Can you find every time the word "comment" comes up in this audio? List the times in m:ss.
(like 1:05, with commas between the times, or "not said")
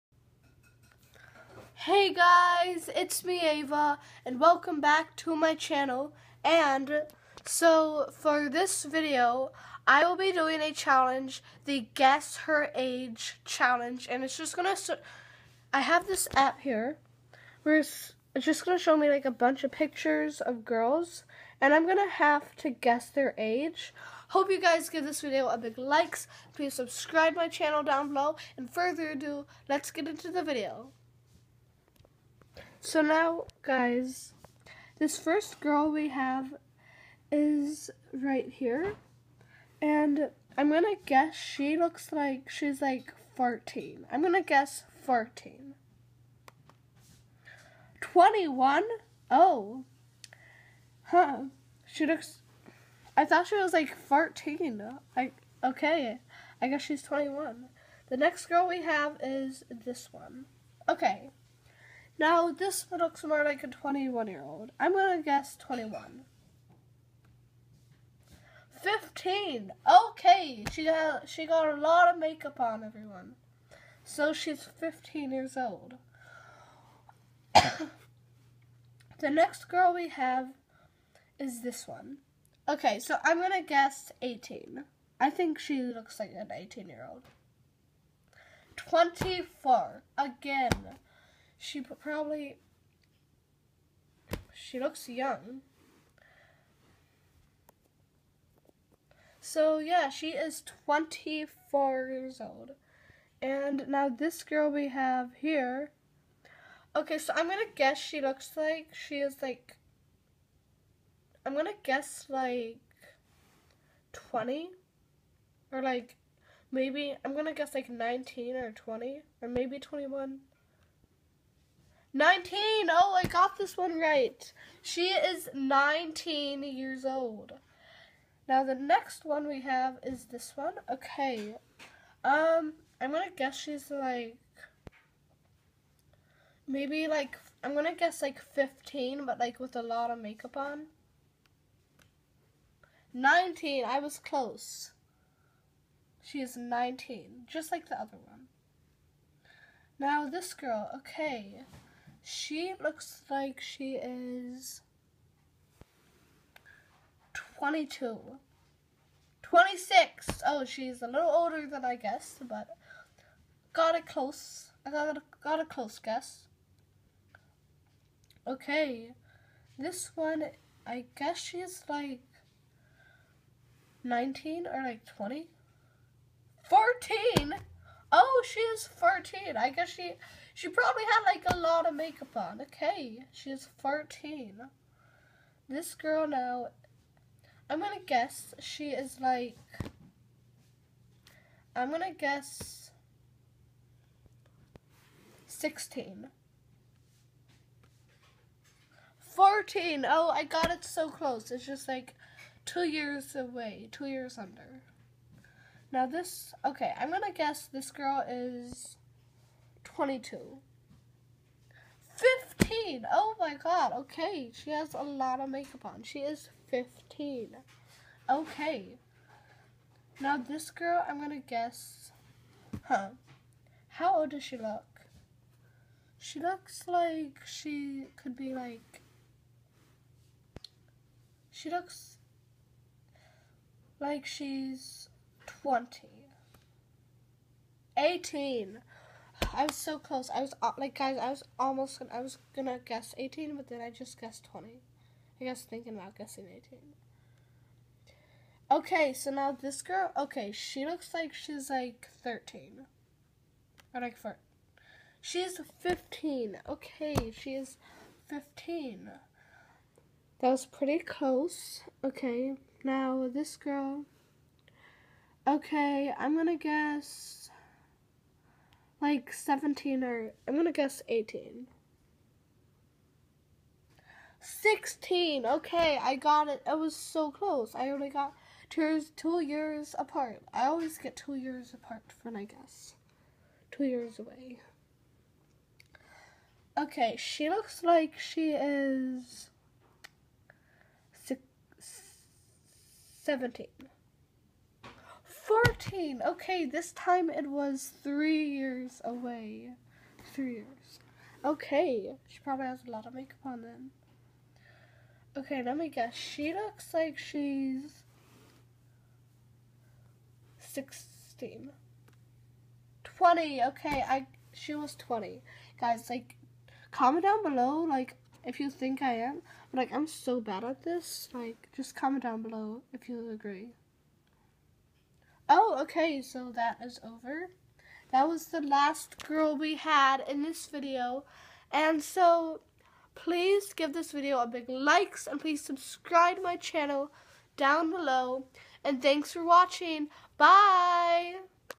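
5:16, 5:21.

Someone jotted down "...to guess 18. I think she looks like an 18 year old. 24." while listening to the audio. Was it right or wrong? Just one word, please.
right.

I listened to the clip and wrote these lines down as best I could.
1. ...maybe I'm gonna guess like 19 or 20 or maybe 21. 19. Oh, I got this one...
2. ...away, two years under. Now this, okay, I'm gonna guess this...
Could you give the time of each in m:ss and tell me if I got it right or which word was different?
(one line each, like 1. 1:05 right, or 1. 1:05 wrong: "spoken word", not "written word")
1. 1:56 right
2. 3:23 right.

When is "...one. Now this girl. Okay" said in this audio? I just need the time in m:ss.
2:28.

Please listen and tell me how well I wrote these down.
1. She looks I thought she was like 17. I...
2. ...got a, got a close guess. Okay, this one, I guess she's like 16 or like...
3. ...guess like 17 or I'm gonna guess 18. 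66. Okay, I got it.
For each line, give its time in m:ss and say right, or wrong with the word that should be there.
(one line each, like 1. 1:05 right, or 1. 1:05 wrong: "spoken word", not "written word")
1. 0:51 wrong: "14", not "17"
2. 2:44 wrong: "19", not "16"
3. 4:26 wrong: "16", not "66".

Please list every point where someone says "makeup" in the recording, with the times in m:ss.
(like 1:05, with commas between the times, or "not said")
1:12, 2:20, 3:01, 3:35, 5:03.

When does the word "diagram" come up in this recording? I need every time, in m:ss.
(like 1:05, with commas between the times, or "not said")
not said.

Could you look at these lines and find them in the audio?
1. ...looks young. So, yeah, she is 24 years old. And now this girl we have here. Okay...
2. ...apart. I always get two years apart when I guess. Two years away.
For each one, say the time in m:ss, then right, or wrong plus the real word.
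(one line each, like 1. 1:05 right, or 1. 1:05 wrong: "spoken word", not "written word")
1. 1:34 right
2. 4:39 right.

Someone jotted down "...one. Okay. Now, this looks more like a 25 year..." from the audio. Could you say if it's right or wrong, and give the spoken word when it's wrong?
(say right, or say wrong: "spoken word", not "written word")
wrong: "21", not "25".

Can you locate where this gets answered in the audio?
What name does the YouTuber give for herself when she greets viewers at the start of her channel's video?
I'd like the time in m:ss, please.
0:03.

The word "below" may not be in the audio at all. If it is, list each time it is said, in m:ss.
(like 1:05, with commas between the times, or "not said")
0:28, 5:17, 5:22, 5:37.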